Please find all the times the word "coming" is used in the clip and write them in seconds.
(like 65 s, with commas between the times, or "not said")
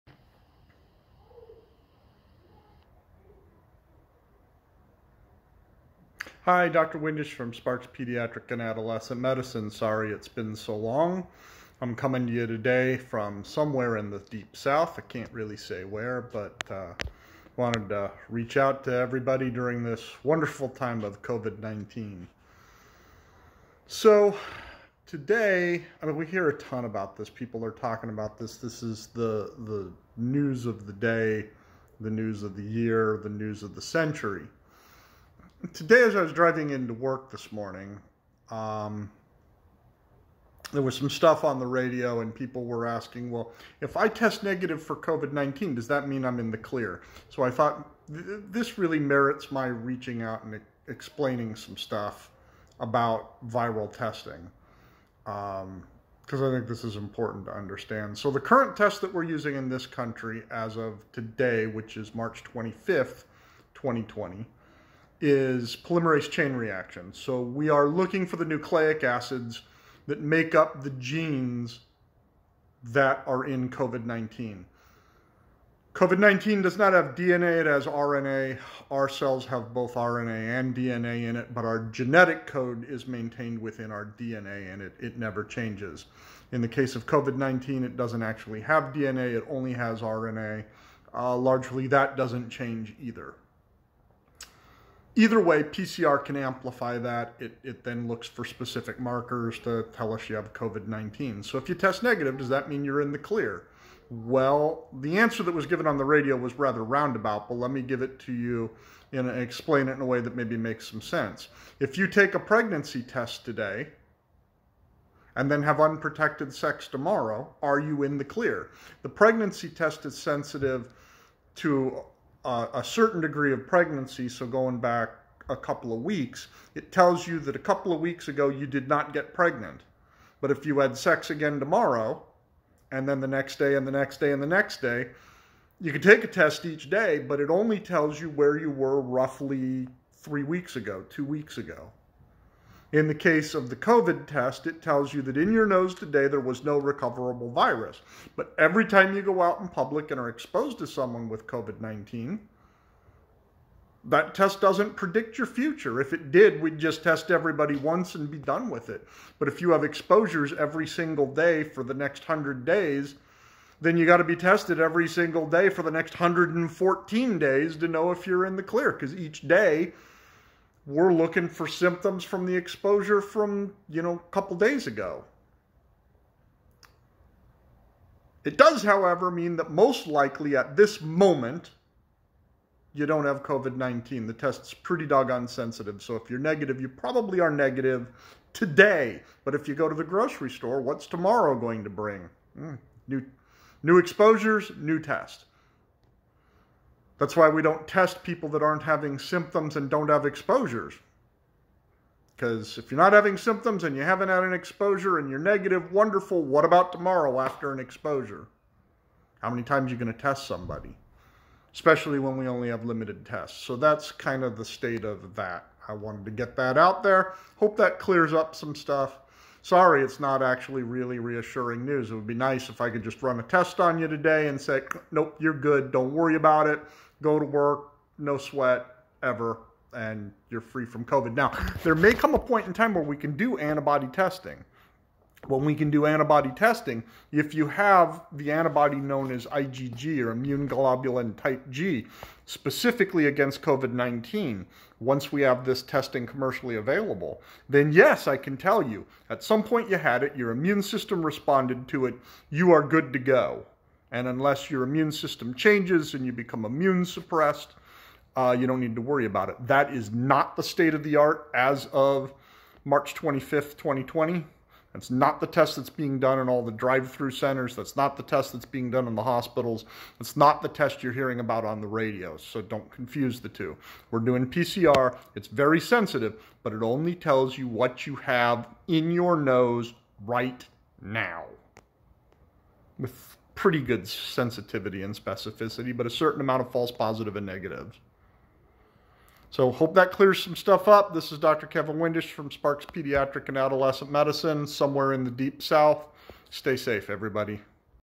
11 s.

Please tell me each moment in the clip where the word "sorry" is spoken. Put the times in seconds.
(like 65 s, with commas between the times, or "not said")
9 s, 219 s.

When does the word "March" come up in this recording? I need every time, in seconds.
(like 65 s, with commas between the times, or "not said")
62 s, 262 s.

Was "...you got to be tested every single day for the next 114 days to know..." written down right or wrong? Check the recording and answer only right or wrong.
right.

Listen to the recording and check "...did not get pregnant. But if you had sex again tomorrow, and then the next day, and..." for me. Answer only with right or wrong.
right.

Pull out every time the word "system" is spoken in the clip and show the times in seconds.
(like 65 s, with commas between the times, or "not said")
250 s, 255 s.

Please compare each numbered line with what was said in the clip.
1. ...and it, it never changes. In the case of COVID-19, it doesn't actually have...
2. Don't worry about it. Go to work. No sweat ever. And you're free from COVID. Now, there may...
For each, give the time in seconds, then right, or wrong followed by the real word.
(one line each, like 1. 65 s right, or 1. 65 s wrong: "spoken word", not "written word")
1. 84 s right
2. 225 s right.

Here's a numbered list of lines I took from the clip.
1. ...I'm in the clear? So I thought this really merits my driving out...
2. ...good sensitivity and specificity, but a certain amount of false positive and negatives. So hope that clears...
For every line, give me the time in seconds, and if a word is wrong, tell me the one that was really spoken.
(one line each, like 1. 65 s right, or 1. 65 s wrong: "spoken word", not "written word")
1. 46 s wrong: "reaching", not "driving"
2. 283 s right.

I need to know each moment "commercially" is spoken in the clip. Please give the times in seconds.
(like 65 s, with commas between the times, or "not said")
246 s.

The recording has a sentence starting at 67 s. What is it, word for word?
So we are looking for the nucleic acids that make up the genes that are in COVID-19.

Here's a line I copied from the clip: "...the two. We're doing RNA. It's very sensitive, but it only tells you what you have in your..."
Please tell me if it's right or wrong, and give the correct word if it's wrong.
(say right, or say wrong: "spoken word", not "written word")
wrong: "PCR", not "RNA".